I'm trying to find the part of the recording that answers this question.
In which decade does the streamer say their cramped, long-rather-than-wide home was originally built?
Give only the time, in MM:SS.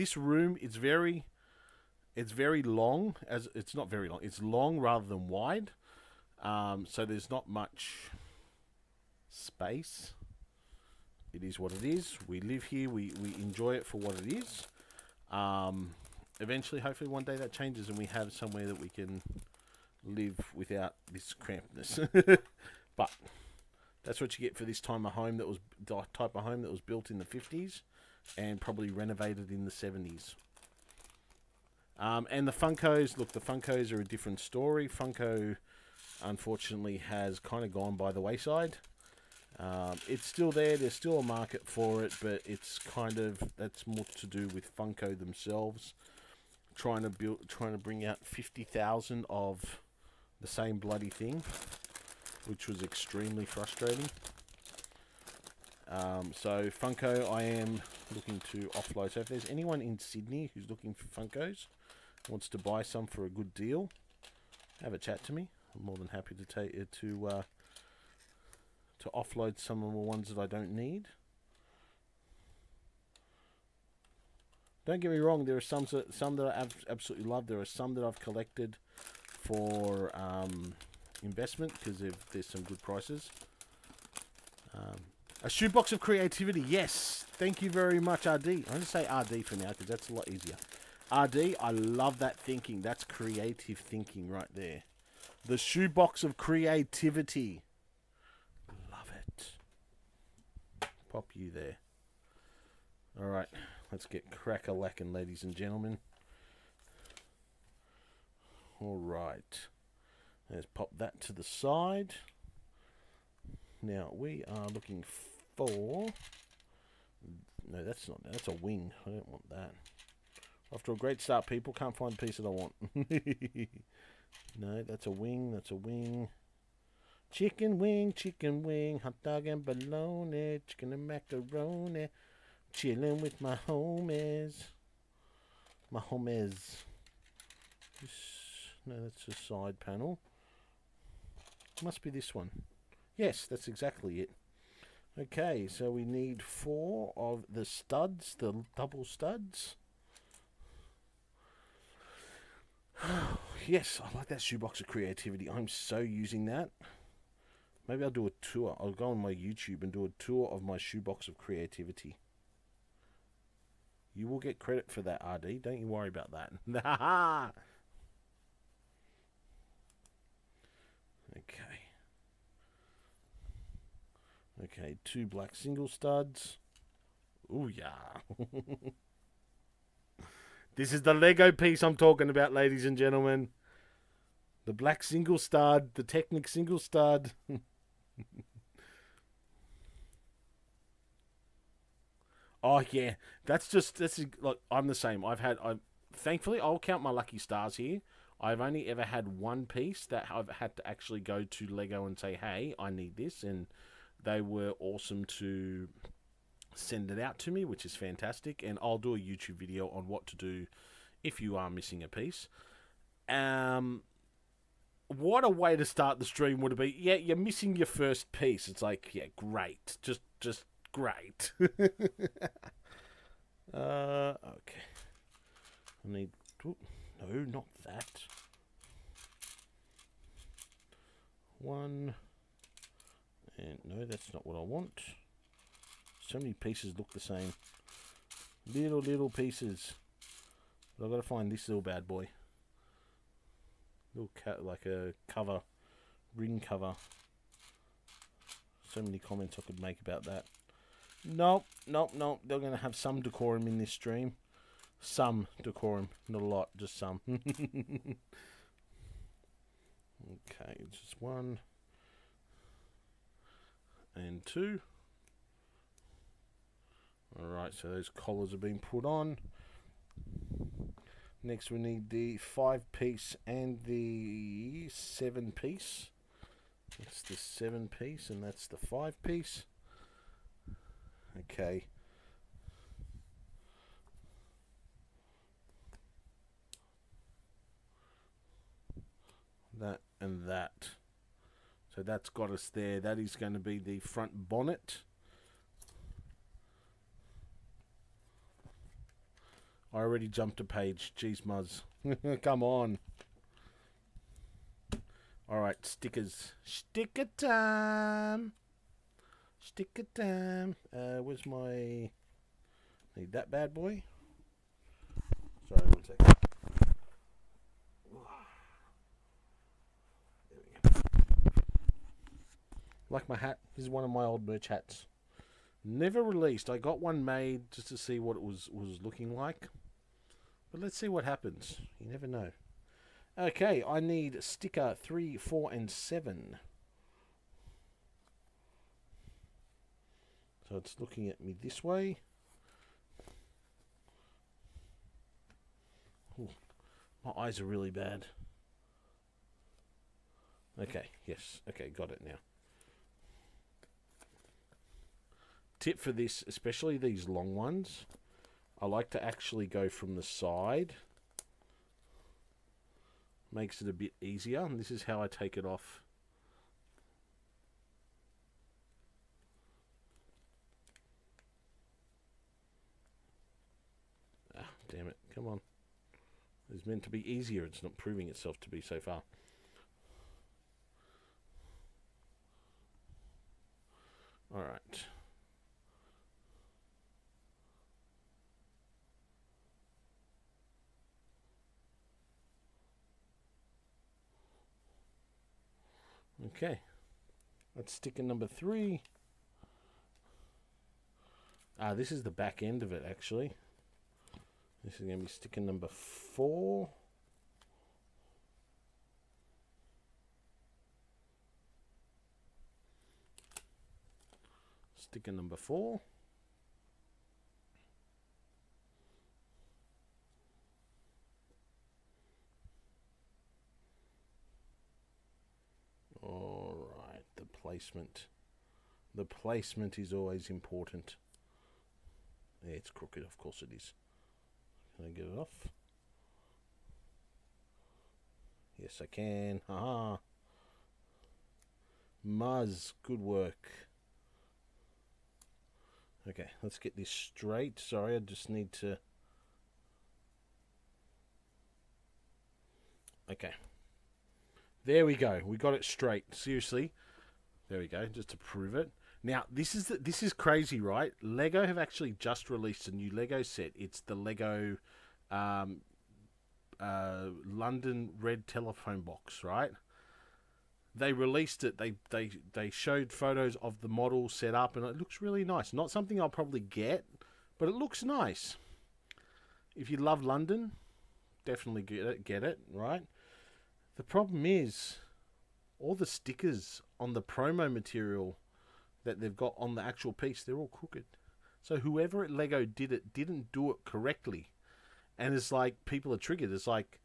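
00:27.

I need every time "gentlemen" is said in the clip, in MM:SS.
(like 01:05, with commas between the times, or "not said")
01:45, 03:02.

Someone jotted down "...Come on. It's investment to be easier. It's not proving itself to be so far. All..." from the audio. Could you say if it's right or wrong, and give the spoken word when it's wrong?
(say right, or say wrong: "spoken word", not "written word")
wrong: "meant", not "investment".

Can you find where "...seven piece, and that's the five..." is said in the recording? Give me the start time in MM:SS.
04:37.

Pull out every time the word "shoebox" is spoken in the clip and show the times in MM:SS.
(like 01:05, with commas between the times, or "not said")
01:25, 01:35, 02:34, 02:40.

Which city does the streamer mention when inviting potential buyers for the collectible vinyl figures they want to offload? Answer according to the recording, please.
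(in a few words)
Sydney.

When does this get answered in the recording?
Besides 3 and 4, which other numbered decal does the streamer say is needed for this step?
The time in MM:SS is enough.
05:35.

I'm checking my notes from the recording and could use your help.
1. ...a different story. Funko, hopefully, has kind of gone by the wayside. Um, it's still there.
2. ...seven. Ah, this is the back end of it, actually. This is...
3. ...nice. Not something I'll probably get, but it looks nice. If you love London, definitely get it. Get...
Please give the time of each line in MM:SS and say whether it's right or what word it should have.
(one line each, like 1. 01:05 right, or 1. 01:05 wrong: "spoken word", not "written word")
1. 00:34 wrong: "unfortunately", not "hopefully"
2. 06:38 wrong: "three", not "seven"
3. 07:55 right.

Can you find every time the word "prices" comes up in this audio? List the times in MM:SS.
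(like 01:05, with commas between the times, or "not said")
01:22.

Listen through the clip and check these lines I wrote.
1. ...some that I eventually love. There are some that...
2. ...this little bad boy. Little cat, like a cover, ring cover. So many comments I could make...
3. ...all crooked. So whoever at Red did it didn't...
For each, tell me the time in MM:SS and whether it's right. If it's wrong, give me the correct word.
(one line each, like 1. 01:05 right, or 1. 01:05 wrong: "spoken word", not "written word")
1. 01:16 wrong: "absolutely", not "eventually"
2. 04:01 right
3. 08:10 wrong: "Lego", not "Red".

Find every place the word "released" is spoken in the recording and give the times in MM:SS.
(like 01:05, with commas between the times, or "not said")
05:26, 07:42, 07:51.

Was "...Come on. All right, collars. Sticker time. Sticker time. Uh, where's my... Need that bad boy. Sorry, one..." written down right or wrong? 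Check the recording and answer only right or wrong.
wrong.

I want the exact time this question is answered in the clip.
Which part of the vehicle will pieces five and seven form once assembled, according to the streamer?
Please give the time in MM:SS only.
04:54.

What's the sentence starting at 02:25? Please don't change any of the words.
Okay, so we need four of the studs, the double studs.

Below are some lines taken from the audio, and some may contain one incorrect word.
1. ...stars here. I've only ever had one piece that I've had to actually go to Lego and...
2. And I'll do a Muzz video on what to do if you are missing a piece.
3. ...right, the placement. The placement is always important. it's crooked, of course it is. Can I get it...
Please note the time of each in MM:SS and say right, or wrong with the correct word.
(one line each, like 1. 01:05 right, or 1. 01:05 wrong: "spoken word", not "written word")
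1. 03:17 right
2. 03:28 wrong: "YouTube", not "Muzz"
3. 07:07 right.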